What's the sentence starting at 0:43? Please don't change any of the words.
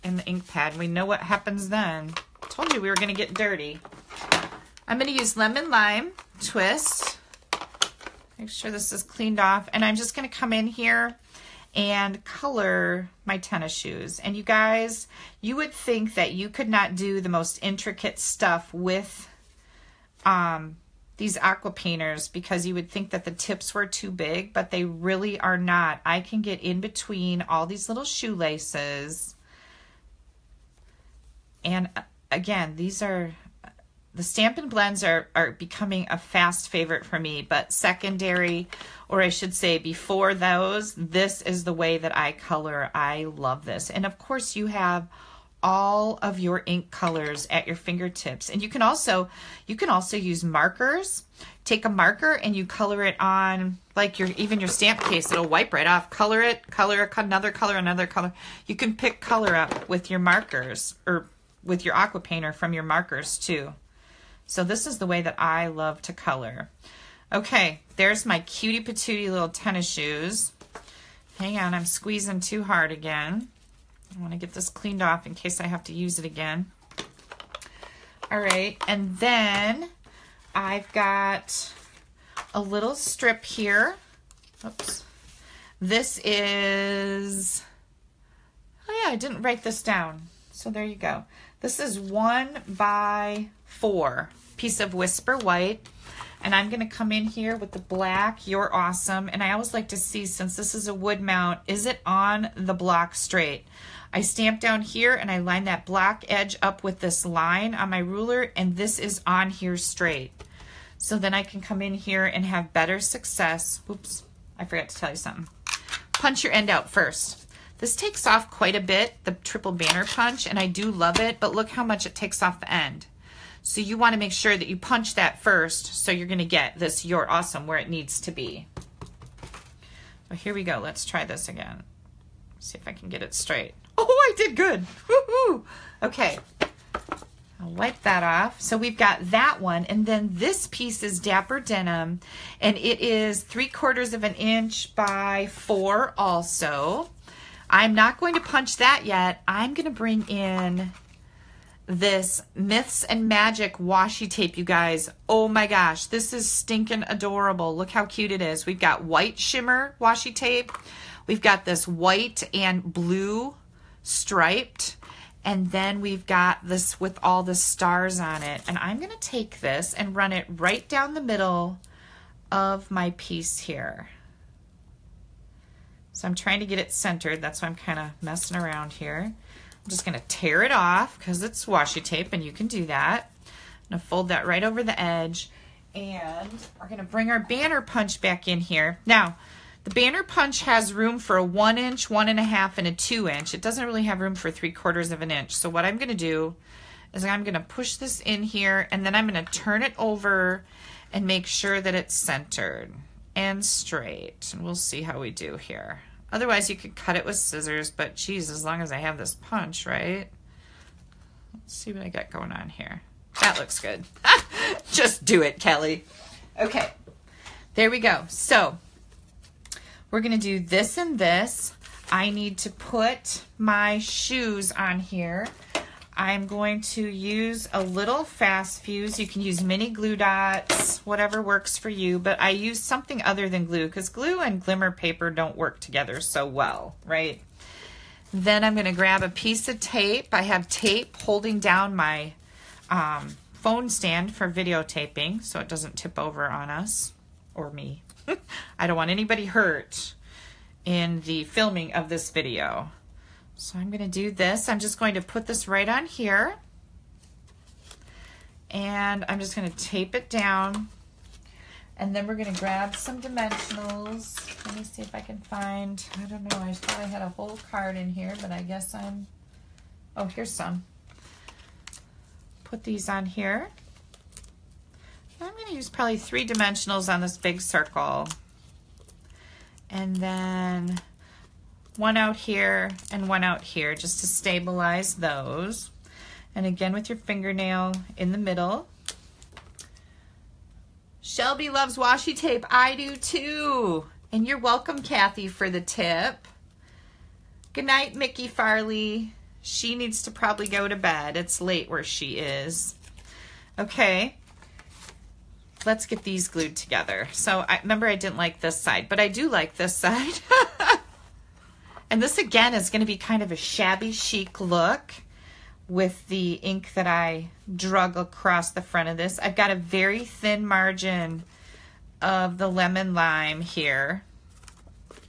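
And of course, you have all of your ink colors at your fingertips.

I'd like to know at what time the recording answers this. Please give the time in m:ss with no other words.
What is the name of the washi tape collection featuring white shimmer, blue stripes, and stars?
2:32.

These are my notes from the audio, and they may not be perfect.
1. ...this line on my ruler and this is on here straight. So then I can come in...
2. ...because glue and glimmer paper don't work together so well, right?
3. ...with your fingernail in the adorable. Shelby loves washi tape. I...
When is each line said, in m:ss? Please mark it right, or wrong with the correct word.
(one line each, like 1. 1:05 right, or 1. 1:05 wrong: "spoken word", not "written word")
1. 1:46 right
2. 3:53 right
3. 4:46 wrong: "middle", not "adorable".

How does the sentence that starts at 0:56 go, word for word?
Color it, color another color, another color.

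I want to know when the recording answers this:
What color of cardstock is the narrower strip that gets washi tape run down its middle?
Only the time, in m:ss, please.
2:21.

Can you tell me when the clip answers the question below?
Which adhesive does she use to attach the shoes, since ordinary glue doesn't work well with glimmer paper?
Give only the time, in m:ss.
3:48.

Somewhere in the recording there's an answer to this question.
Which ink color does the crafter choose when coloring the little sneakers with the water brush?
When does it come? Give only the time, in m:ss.
0:05.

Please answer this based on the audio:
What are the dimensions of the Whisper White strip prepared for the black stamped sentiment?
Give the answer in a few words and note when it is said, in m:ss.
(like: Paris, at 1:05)
1 by 4, at 1:31.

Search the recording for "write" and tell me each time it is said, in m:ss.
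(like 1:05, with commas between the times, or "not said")
1:29.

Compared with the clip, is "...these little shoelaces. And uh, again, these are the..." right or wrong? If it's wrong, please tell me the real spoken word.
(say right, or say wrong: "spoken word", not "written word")
right.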